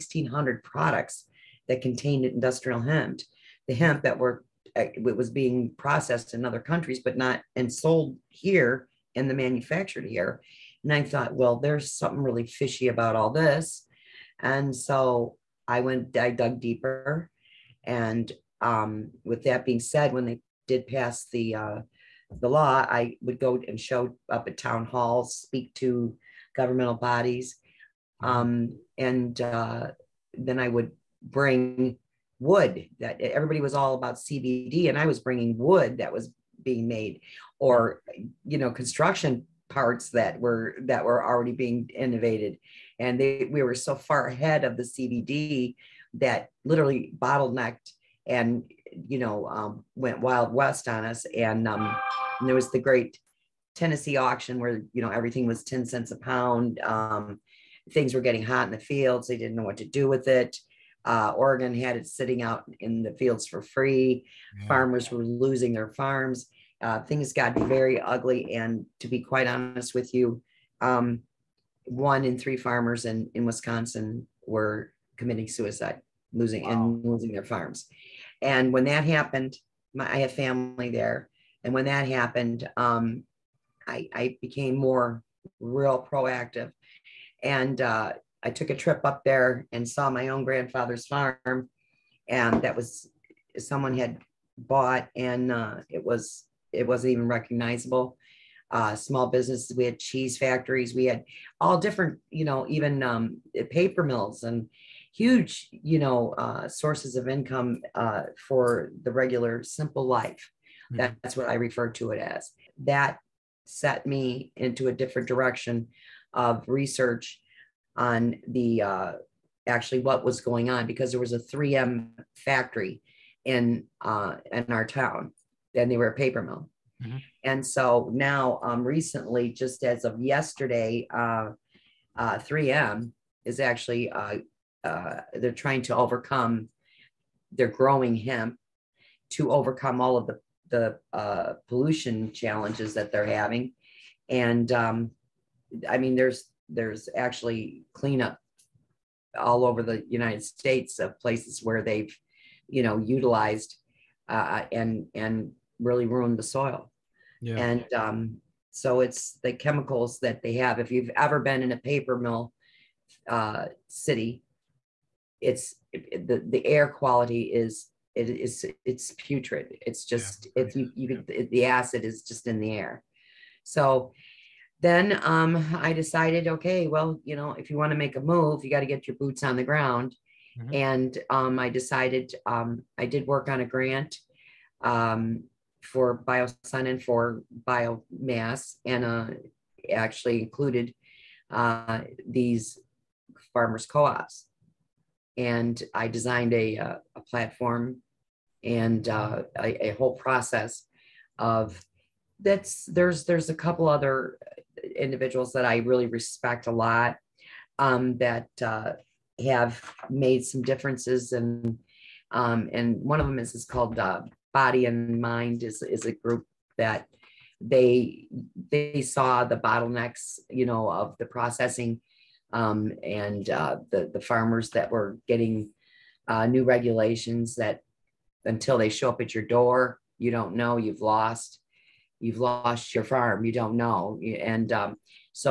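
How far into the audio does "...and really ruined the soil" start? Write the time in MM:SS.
02:35.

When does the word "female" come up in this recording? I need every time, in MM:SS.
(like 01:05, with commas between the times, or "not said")
not said.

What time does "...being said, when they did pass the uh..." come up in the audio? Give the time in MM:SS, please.
00:19.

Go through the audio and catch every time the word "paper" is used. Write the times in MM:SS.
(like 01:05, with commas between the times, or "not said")
01:43, 02:06, 02:41.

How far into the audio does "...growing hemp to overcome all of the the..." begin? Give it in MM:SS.
02:17.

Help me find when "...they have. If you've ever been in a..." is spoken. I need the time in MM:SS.
02:40.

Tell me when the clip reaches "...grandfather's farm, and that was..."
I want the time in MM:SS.
01:30.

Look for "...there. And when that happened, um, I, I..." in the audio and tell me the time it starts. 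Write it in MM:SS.
01:20.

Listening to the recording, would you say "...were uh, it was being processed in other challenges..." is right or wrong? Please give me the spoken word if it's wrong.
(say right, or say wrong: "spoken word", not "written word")
wrong: "countries", not "challenges".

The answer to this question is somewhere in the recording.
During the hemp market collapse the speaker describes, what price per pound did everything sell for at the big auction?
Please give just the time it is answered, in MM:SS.
00:55.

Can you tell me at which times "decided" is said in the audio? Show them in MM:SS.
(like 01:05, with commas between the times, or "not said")
02:55, 03:01.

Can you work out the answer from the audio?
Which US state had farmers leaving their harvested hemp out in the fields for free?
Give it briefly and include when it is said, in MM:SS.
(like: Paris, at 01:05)
Oregon, at 01:01.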